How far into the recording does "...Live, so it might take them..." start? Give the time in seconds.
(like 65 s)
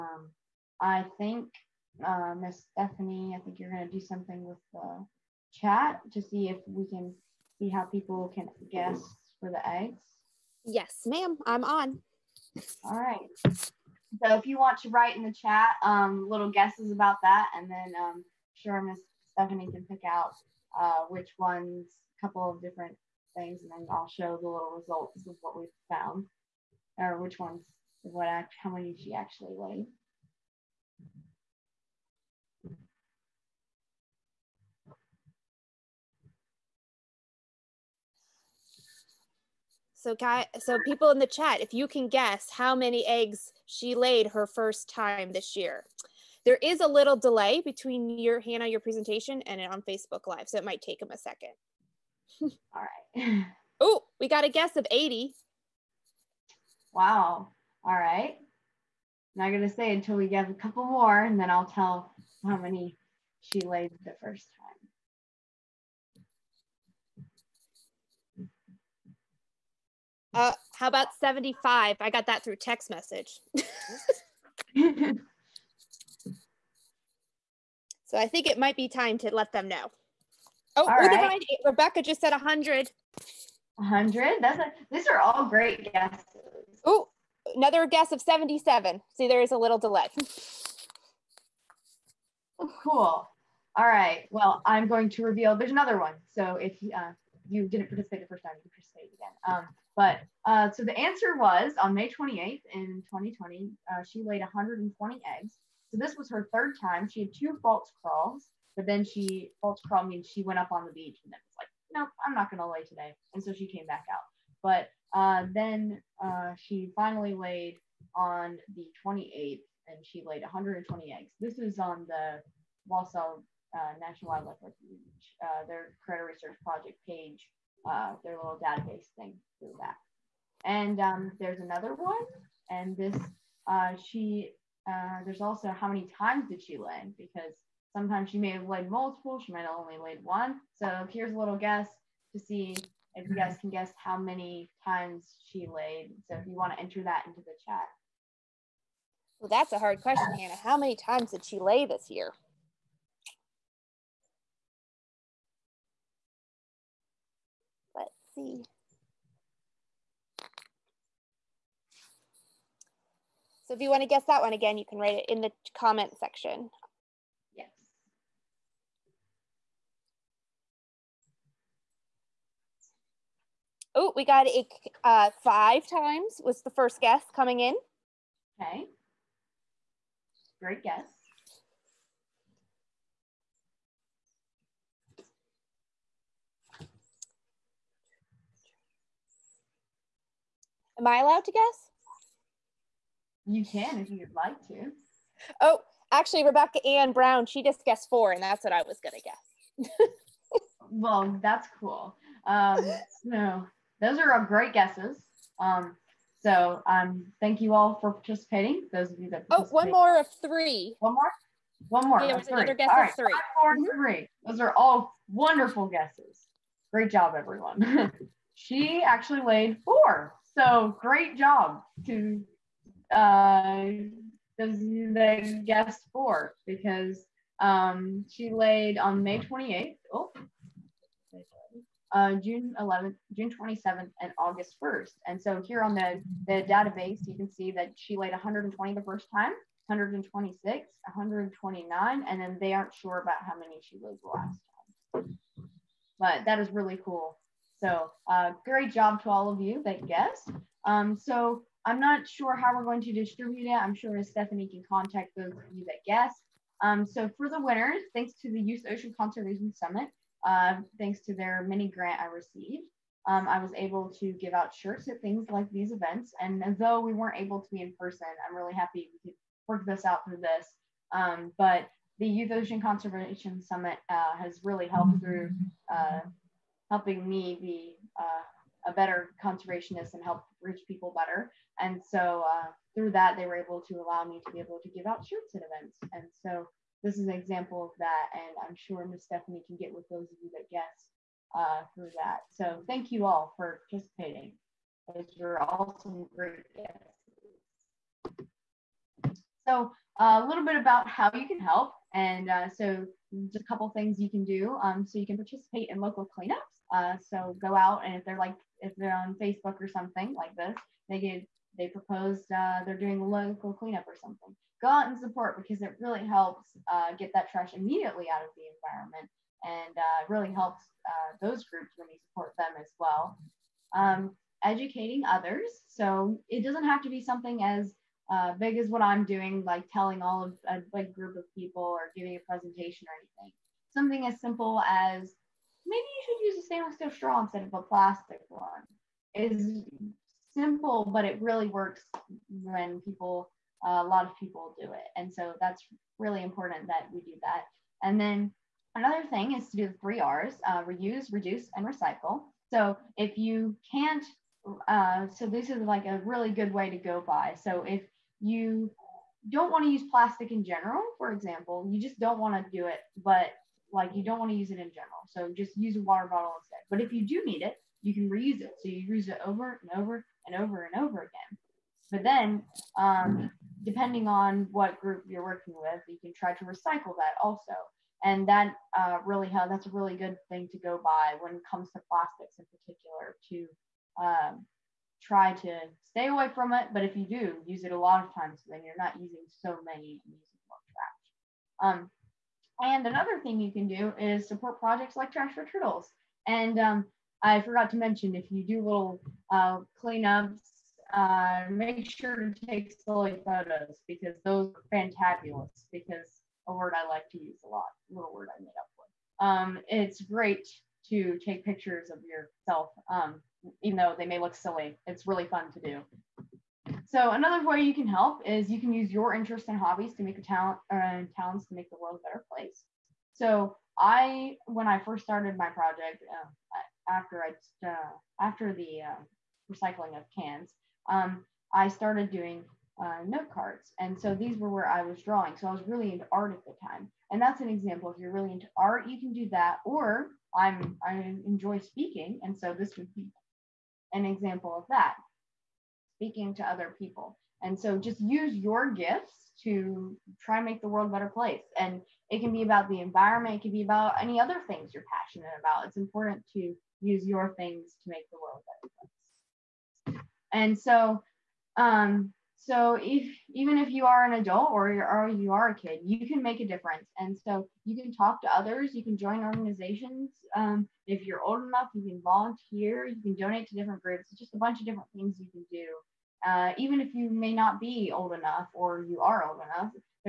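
50 s.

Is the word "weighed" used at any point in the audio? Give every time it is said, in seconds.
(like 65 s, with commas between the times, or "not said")
29 s, 219 s.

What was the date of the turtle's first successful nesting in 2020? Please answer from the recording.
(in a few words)
May 28th.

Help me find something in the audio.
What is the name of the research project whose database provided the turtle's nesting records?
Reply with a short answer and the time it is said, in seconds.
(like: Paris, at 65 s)
Caretta Research Project, at 126 s.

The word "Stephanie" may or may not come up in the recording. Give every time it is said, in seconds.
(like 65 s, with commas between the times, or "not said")
2 s, 19 s, 254 s, 289 s.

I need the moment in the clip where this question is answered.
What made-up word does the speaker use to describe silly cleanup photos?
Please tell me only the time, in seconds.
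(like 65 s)
404 s.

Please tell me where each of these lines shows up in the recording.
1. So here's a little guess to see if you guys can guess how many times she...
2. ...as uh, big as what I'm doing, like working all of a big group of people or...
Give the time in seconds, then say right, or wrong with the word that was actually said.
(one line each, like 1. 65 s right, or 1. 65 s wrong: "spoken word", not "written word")
1. 140 s right
2. 327 s wrong: "telling", not "working".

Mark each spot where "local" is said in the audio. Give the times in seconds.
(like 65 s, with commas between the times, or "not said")
305 s, 313 s.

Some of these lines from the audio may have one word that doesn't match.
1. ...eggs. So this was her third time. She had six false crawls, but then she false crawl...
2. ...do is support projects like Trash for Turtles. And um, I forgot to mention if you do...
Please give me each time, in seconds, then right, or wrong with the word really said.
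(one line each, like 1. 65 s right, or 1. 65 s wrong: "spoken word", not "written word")
1. 105 s wrong: "two", not "six"
2. 393 s right.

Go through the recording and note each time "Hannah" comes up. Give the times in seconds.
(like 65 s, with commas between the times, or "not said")
48 s, 150 s.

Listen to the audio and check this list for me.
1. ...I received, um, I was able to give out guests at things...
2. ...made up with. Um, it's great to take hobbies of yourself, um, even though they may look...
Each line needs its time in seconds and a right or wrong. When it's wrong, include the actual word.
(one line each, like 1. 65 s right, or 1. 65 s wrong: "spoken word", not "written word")
1. 262 s wrong: "shirts", not "guests"
2. 408 s wrong: "pictures", not "hobbies".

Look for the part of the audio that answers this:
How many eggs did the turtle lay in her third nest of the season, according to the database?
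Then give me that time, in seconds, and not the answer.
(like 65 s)
240 s.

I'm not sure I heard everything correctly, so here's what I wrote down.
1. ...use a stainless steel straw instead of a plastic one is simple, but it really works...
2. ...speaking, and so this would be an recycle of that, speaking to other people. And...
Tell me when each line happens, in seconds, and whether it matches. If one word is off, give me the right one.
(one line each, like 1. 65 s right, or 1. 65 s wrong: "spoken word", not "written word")
1. 336 s right
2. 441 s wrong: "example", not "recycle".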